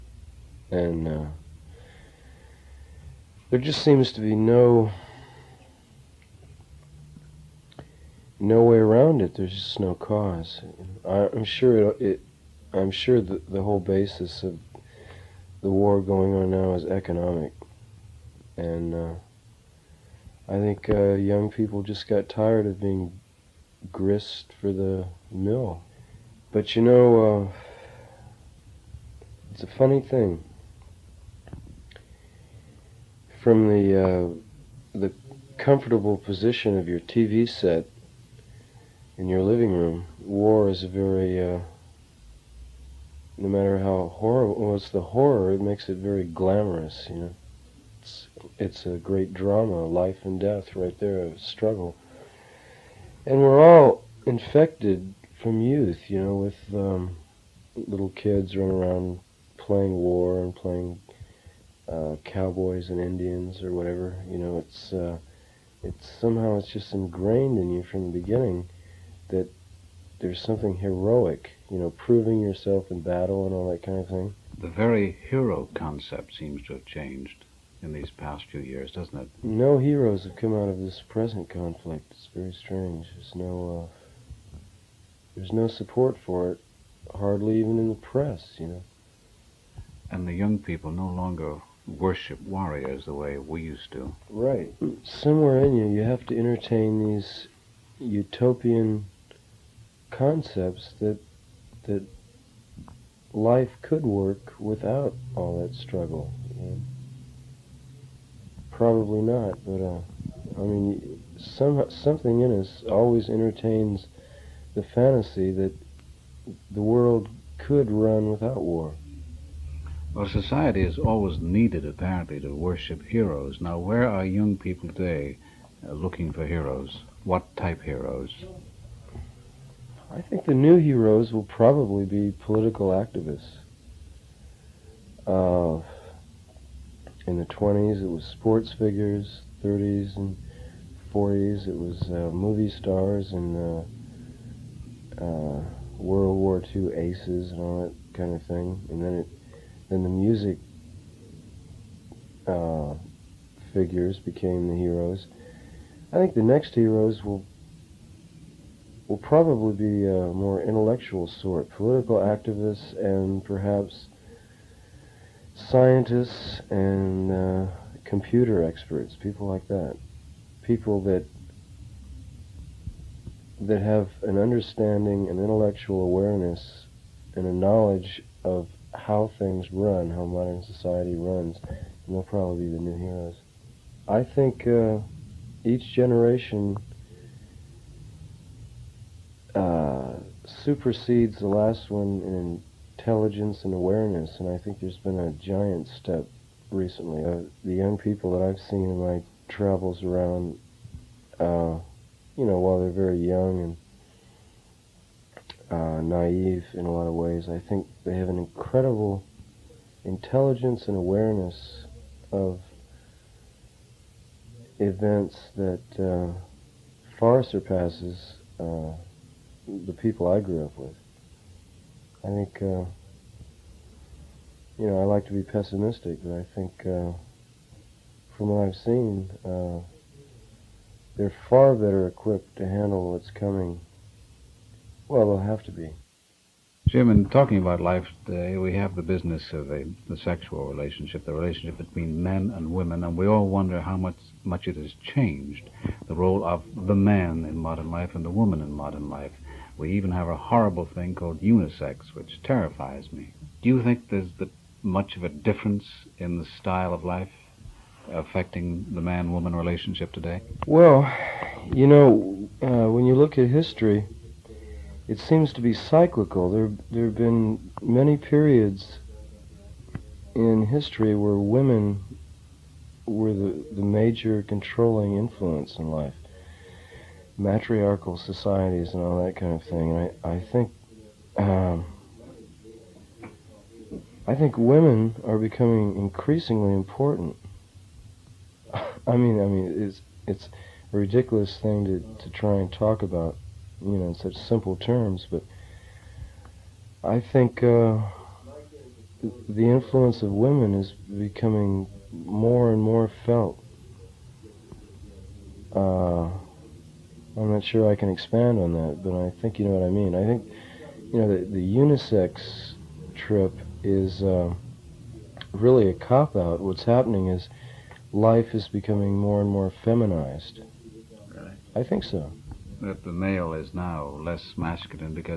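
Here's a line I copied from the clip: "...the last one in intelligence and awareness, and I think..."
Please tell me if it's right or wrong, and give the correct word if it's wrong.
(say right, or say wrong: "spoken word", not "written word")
right.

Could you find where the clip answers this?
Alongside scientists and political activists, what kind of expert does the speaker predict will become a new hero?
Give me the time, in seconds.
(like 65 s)
168 s.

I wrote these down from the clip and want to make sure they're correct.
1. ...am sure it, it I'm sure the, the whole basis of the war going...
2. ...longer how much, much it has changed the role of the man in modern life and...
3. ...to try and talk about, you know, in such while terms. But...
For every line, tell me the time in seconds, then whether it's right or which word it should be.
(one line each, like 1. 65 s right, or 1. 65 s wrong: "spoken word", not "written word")
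1. 11 s right
2. 243 s wrong: "wonder", not "longer"
3. 292 s wrong: "simple", not "while".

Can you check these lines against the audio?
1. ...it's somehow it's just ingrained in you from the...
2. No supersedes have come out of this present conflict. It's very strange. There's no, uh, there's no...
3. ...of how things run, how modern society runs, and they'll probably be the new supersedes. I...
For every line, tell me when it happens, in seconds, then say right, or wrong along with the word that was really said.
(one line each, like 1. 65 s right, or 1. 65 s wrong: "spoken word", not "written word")
1. 65 s right
2. 79 s wrong: "heroes", not "supersedes"
3. 178 s wrong: "heroes", not "supersedes".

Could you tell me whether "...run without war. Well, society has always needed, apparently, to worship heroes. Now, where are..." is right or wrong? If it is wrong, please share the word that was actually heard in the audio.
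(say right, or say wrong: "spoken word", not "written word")
right.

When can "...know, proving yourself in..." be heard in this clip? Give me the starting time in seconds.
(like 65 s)
71 s.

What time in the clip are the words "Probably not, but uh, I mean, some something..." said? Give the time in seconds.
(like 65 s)
108 s.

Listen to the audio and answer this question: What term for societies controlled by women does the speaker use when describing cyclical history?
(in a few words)
matriarchal societies.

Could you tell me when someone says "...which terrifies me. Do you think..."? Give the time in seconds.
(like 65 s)
252 s.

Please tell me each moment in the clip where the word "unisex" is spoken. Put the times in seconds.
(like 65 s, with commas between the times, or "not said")
251 s, 311 s.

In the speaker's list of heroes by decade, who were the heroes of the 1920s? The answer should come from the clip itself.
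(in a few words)
sports figures.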